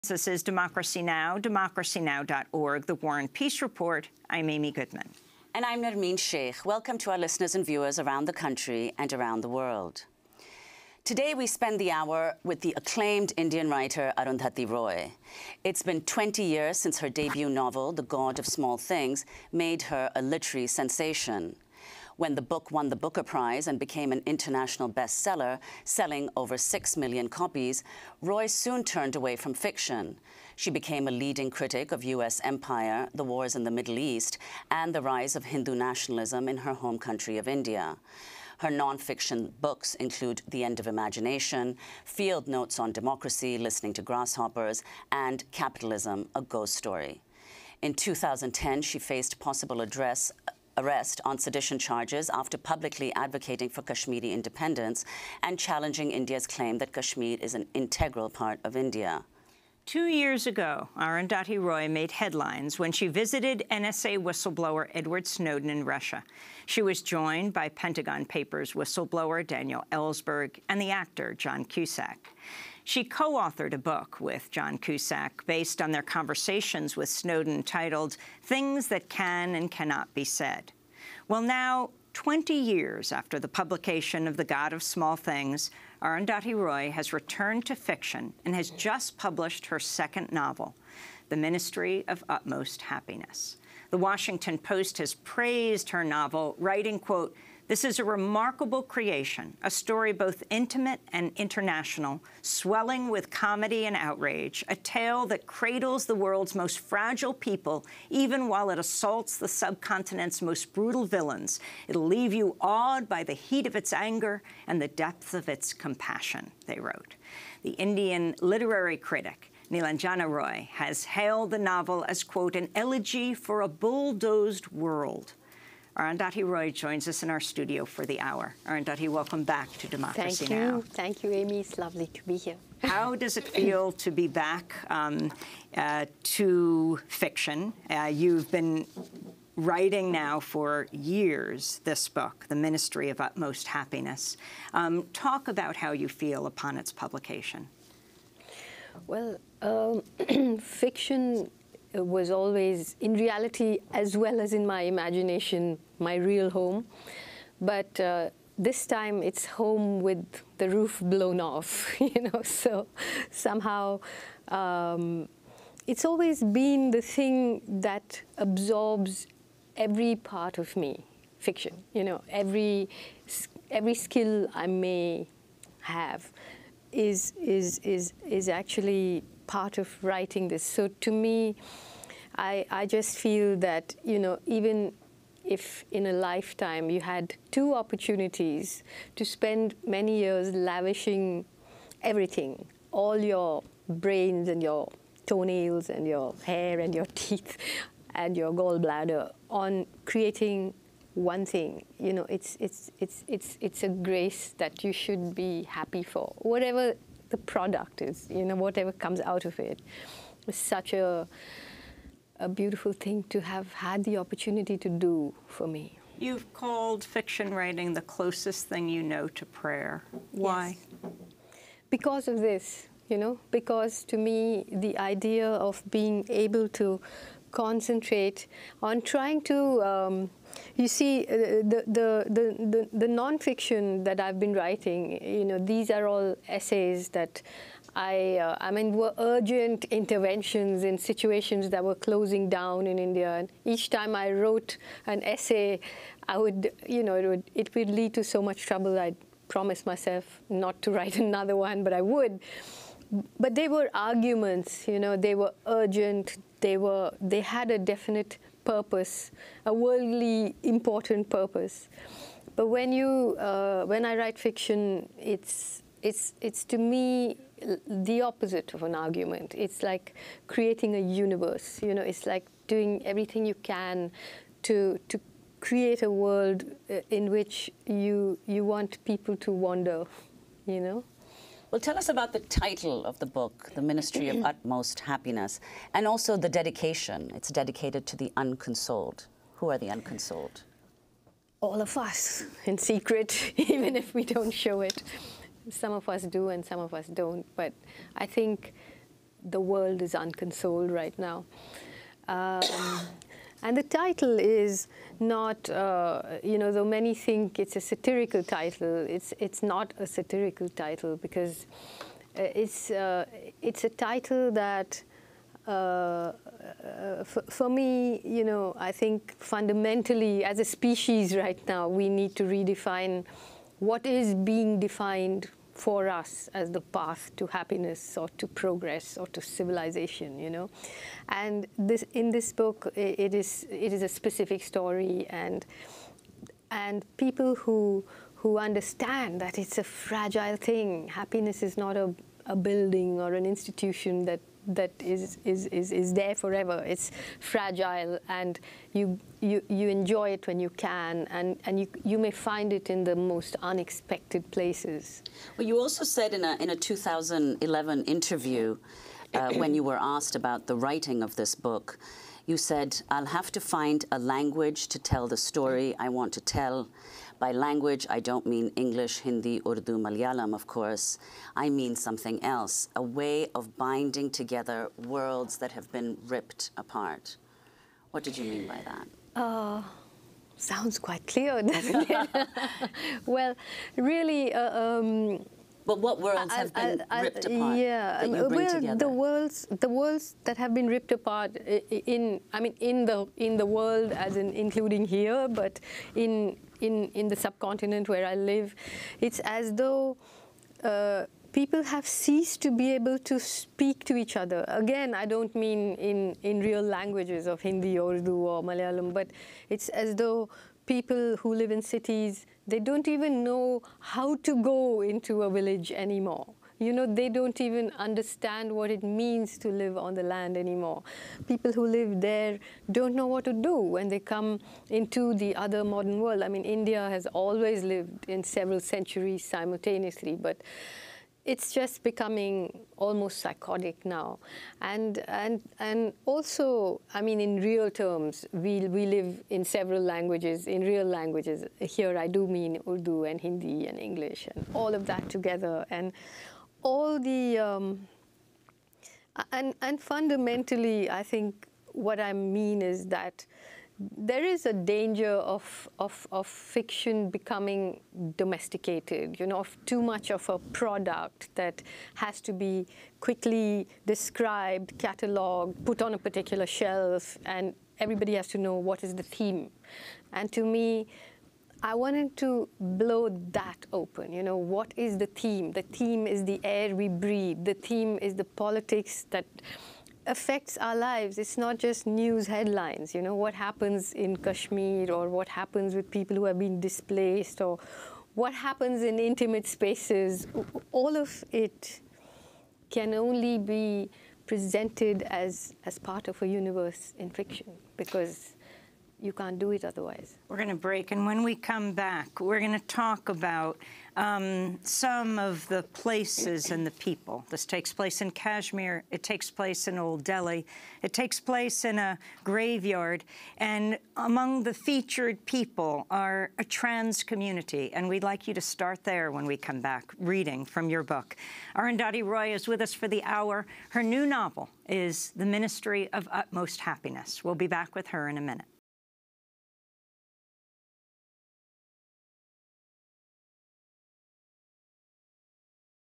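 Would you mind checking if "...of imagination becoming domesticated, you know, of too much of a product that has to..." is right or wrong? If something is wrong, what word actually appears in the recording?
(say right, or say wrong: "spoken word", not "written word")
wrong: "fiction", not "imagination".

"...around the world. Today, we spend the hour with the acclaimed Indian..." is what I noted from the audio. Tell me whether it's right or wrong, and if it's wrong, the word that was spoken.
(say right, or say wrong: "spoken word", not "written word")
right.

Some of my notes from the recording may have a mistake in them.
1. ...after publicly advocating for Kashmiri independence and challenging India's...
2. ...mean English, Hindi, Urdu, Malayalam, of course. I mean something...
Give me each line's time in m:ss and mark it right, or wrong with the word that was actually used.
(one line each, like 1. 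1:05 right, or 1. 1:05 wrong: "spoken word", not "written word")
1. 0:52 right
2. 6:08 right.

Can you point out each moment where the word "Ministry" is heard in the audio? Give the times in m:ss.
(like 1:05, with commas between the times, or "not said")
1:31, 2:22, 4:43, 8:45.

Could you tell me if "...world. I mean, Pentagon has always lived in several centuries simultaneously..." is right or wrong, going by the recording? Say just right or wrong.
wrong.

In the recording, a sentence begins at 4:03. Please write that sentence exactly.
And each time I wrote an essay, I would, you know, it would, it would lead to so much trouble.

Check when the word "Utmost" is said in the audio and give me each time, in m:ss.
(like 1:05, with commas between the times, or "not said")
1:32, 2:23, 4:44, 8:46.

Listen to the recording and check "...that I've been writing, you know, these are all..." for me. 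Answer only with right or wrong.
right.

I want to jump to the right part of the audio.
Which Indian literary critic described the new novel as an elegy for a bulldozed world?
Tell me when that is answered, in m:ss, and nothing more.
1:59.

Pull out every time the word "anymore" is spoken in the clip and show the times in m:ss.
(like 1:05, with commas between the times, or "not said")
6:55, 7:00.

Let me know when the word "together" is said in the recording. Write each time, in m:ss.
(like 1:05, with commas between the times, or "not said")
6:14, 7:25.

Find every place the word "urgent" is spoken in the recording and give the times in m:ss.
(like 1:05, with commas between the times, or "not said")
3:59, 4:15.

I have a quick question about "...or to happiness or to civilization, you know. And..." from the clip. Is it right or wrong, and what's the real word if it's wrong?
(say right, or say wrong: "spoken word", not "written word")
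wrong: "progress", not "happiness".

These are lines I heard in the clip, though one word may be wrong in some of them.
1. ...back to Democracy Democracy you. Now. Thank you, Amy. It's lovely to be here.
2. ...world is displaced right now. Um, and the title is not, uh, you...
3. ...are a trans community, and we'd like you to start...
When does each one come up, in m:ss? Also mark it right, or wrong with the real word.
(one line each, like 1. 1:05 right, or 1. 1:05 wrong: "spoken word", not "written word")
1. 2:09 wrong: "Thank", not "Democracy"
2. 4:59 wrong: "unconsoled", not "displaced"
3. 8:36 right.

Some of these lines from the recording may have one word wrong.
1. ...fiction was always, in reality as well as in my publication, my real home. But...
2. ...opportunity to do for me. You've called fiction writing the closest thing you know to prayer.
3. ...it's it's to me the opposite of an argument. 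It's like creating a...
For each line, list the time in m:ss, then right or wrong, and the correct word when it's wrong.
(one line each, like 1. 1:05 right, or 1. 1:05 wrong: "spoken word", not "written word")
1. 2:30 wrong: "imagination", not "publication"
2. 3:34 right
3. 4:26 right.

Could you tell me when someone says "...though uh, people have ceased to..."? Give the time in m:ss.
6:39.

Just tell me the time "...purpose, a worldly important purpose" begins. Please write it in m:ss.
4:18.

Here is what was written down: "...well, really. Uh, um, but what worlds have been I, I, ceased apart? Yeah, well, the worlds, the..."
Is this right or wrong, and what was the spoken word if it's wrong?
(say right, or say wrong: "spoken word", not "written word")
wrong: "ripped", not "ceased".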